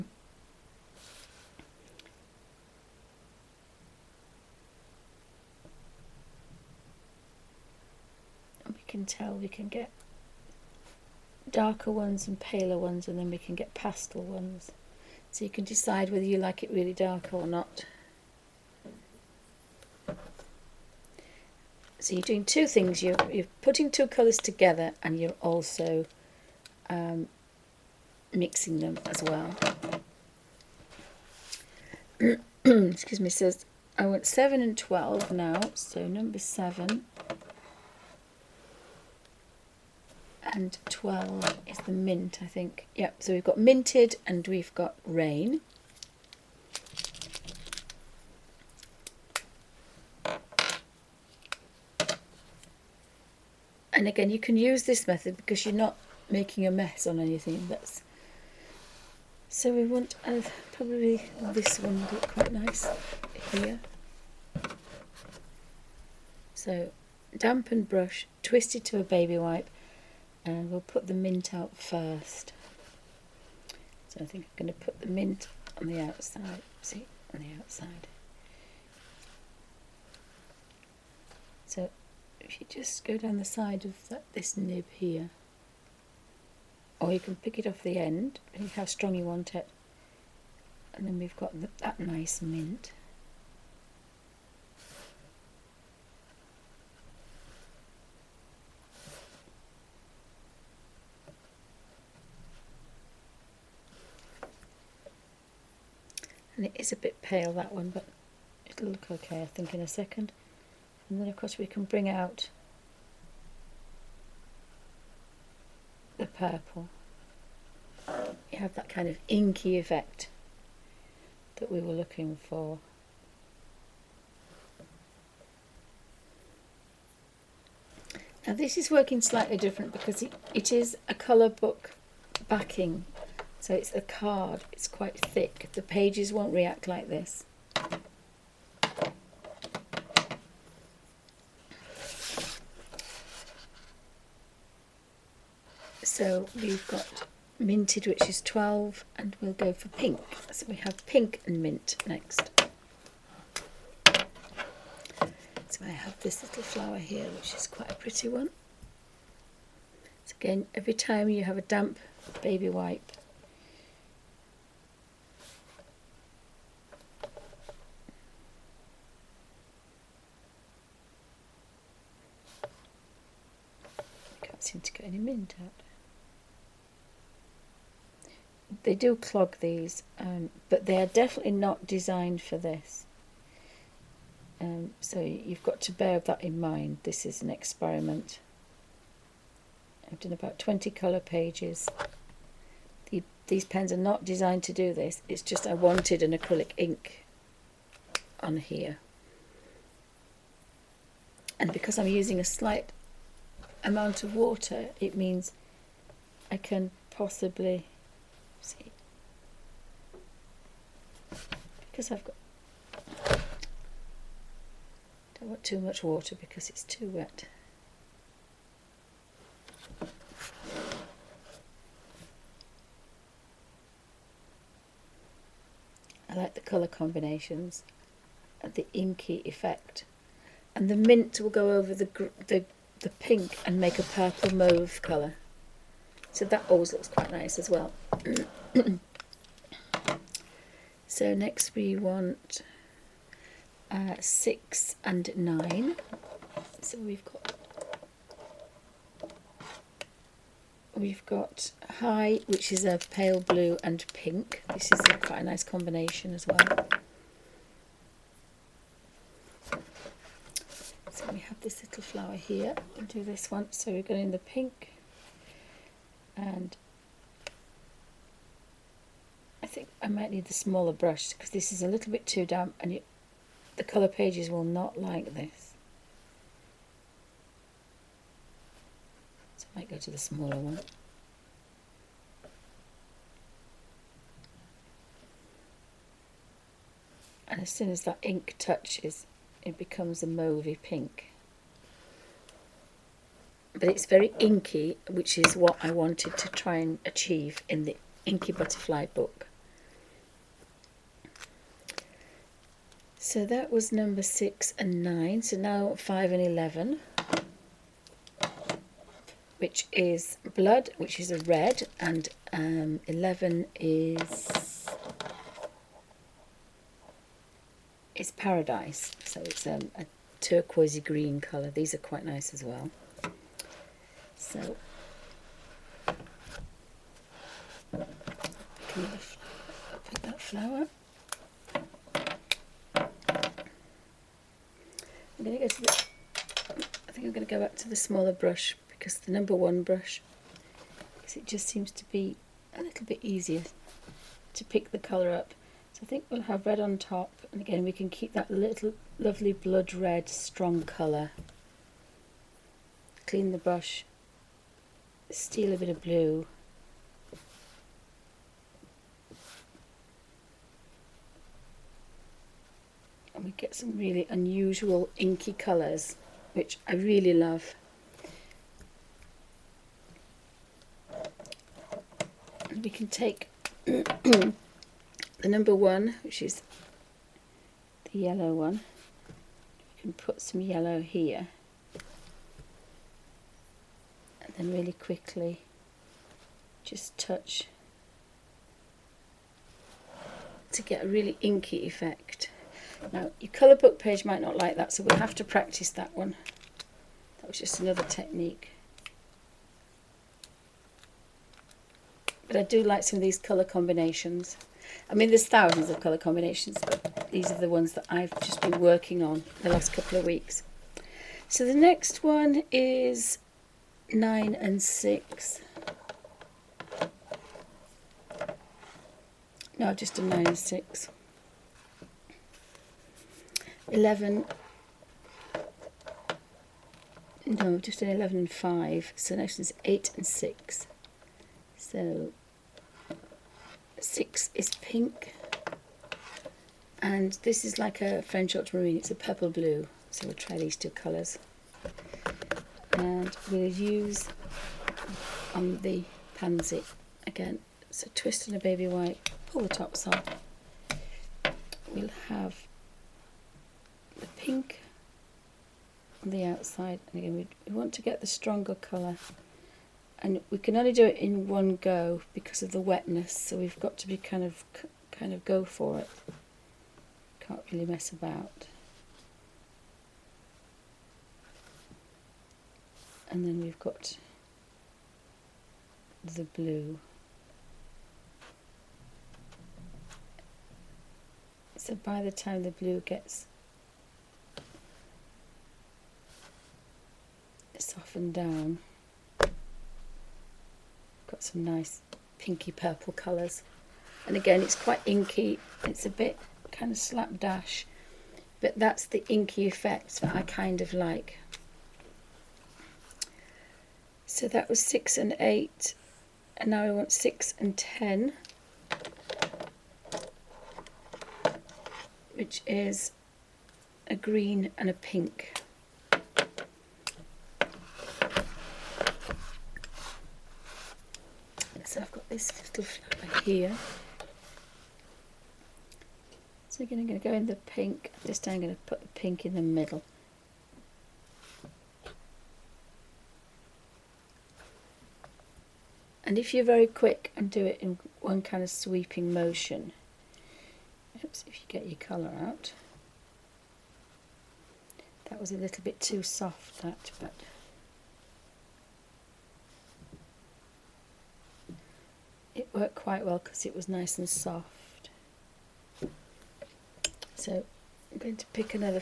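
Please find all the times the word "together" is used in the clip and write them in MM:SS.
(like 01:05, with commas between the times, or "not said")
00:24.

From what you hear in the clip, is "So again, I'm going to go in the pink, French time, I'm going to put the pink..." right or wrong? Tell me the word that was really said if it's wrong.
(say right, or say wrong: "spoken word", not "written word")
wrong: "This", not "French".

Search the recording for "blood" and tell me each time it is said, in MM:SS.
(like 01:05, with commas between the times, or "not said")
05:10, 05:49.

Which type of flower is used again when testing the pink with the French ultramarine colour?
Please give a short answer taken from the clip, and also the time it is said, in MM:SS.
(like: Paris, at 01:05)
Pansy, at 07:25.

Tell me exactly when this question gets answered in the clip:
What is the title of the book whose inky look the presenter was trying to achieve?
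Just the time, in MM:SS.
04:58.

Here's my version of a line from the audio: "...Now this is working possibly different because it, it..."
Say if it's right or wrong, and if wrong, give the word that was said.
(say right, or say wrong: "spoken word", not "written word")
wrong: "slightly", not "possibly".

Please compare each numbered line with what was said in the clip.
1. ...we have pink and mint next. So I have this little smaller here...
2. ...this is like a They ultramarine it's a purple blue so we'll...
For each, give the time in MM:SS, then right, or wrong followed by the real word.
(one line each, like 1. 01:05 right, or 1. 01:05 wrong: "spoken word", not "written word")
1. 02:30 wrong: "flower", not "smaller"
2. 07:17 wrong: "French", not "They".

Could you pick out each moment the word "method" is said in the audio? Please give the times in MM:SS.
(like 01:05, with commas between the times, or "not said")
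00:55.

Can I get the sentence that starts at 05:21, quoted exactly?
These are quite nice as well.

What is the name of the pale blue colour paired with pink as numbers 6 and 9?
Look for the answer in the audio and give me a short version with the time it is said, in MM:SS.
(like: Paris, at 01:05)
High, at 04:12.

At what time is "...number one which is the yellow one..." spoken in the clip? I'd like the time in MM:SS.
06:15.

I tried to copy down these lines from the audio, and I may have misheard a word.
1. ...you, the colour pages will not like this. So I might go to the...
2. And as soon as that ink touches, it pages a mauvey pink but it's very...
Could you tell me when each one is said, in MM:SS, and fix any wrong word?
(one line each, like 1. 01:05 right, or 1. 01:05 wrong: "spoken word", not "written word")
1. 04:32 right
2. 04:47 wrong: "becomes", not "pages".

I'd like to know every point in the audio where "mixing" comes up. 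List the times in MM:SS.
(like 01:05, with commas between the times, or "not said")
00:28.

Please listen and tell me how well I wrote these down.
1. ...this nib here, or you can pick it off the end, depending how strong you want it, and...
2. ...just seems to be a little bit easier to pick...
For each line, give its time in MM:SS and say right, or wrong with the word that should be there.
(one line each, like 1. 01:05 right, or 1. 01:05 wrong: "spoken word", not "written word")
1. 01:24 right
2. 05:41 right.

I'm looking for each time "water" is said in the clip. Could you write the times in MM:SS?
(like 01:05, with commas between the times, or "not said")
03:24, 03:36.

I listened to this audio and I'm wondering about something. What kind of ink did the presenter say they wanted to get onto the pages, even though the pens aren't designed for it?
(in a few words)
Acrylic ink.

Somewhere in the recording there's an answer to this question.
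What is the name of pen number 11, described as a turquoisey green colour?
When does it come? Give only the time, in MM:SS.
05:18.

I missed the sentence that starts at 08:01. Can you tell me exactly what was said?
So by the time the blue gets softened down, got some nice pinky purple colours.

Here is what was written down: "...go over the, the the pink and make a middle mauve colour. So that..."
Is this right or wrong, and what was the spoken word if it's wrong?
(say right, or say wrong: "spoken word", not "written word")
wrong: "purple", not "middle".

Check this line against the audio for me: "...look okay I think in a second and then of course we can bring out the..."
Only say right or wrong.
right.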